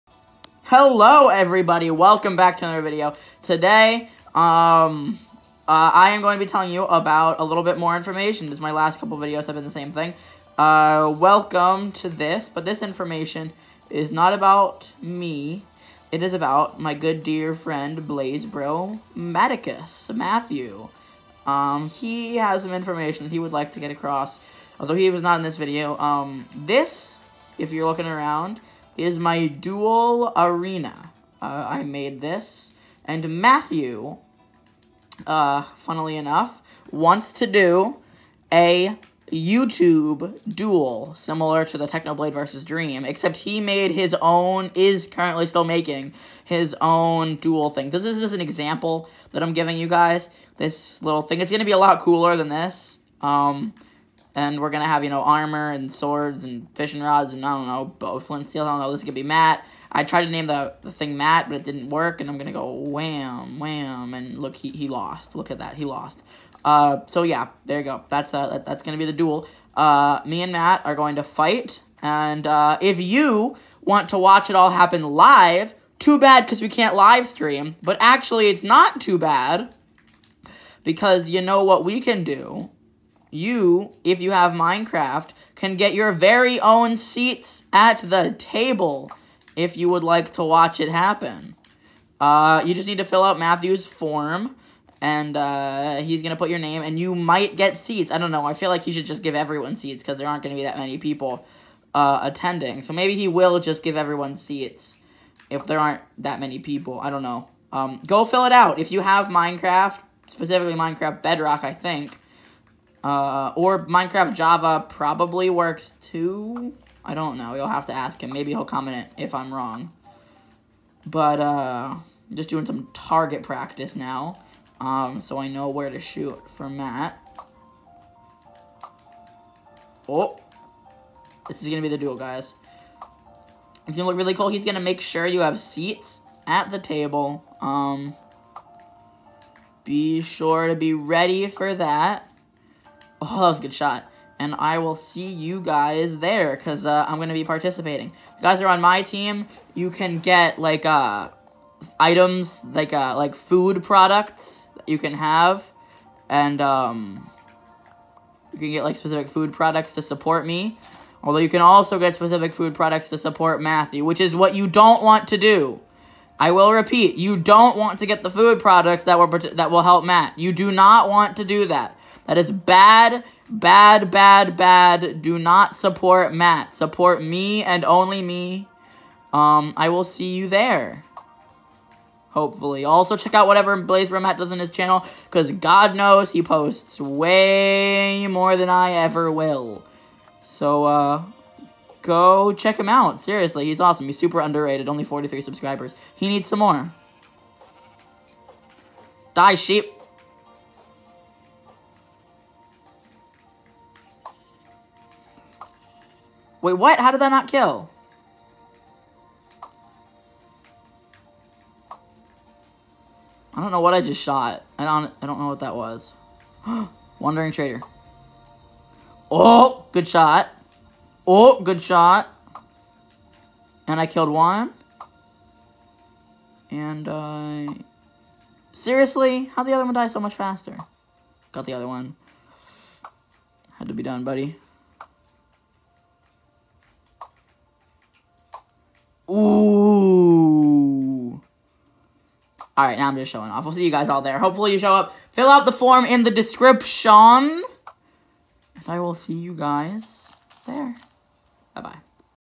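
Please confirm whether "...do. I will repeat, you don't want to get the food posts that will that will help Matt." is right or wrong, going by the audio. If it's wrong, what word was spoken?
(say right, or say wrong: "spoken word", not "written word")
wrong: "products", not "posts".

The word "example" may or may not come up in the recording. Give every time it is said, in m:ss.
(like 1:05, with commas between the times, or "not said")
0:48.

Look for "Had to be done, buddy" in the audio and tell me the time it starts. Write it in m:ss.
3:53.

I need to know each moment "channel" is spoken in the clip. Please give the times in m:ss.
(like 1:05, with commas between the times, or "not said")
3:04.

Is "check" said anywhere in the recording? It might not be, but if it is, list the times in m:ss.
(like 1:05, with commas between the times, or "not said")
3:03, 3:12.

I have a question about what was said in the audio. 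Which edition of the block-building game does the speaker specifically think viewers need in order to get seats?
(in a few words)
Minecraft Bedrock.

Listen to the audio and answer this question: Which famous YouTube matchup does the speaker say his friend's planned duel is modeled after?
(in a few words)
Technoblade versus Dream.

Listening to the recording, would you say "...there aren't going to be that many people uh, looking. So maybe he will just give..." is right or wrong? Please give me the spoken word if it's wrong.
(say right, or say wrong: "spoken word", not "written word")
wrong: "attending", not "looking".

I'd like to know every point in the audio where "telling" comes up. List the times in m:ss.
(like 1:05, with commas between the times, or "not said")
0:06.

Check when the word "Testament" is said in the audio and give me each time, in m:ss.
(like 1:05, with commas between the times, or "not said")
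not said.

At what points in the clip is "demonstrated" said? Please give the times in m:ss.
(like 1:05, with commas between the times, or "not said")
not said.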